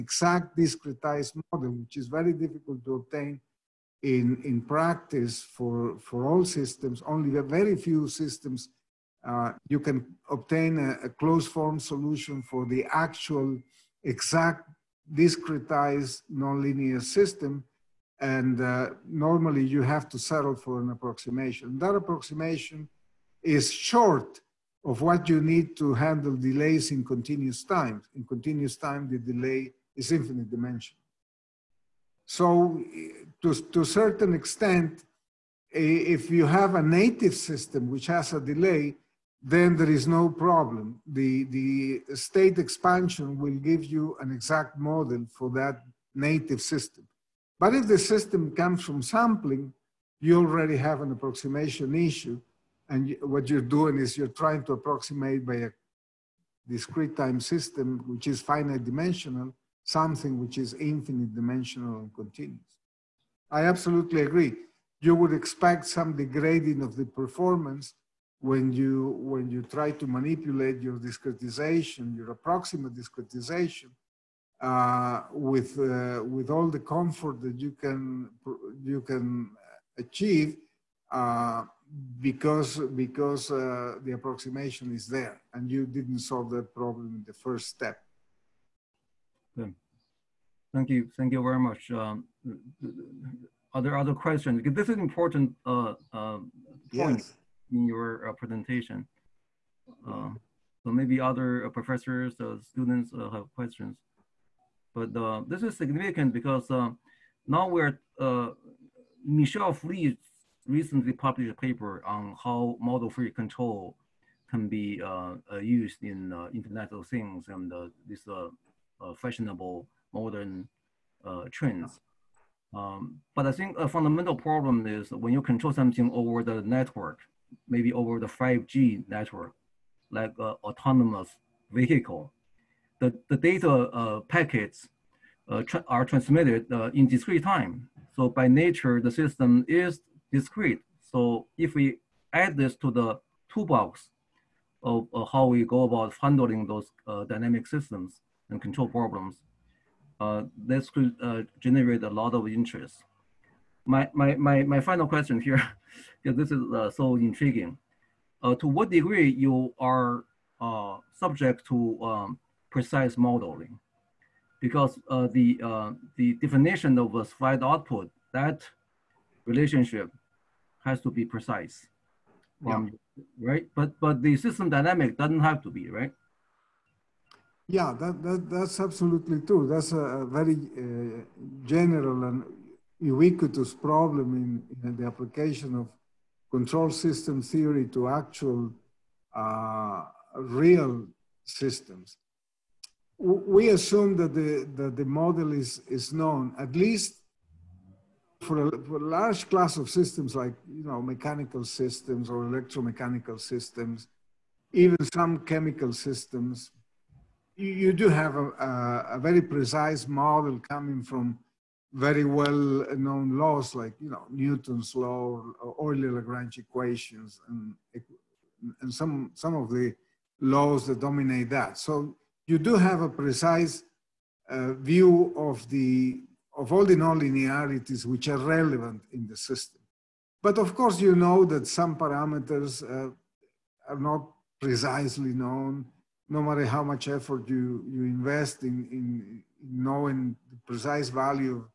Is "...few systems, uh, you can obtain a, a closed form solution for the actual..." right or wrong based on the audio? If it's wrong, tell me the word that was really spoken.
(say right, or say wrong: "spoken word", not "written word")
right.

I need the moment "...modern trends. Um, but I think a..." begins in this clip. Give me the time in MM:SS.
02:00.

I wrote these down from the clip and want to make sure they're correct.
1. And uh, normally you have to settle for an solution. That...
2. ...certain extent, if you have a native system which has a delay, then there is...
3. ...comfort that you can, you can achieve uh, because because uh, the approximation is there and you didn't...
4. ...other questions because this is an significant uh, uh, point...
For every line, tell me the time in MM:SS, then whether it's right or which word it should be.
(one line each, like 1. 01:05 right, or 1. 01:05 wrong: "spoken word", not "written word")
1. 00:18 wrong: "approximation", not "solution"
2. 00:33 right
3. 01:16 right
4. 01:33 wrong: "important", not "significant".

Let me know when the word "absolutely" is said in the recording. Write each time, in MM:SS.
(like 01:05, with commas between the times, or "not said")
01:03, 02:58.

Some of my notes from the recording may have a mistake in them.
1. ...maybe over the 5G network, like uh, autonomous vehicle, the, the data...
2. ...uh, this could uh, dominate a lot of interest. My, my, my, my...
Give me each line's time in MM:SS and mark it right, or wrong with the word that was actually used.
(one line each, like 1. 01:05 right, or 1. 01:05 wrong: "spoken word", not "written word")
1. 02:07 right
2. 02:30 wrong: "generate", not "dominate".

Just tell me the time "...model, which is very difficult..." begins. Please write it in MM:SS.
00:01.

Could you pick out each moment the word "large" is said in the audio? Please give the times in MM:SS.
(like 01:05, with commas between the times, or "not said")
03:19.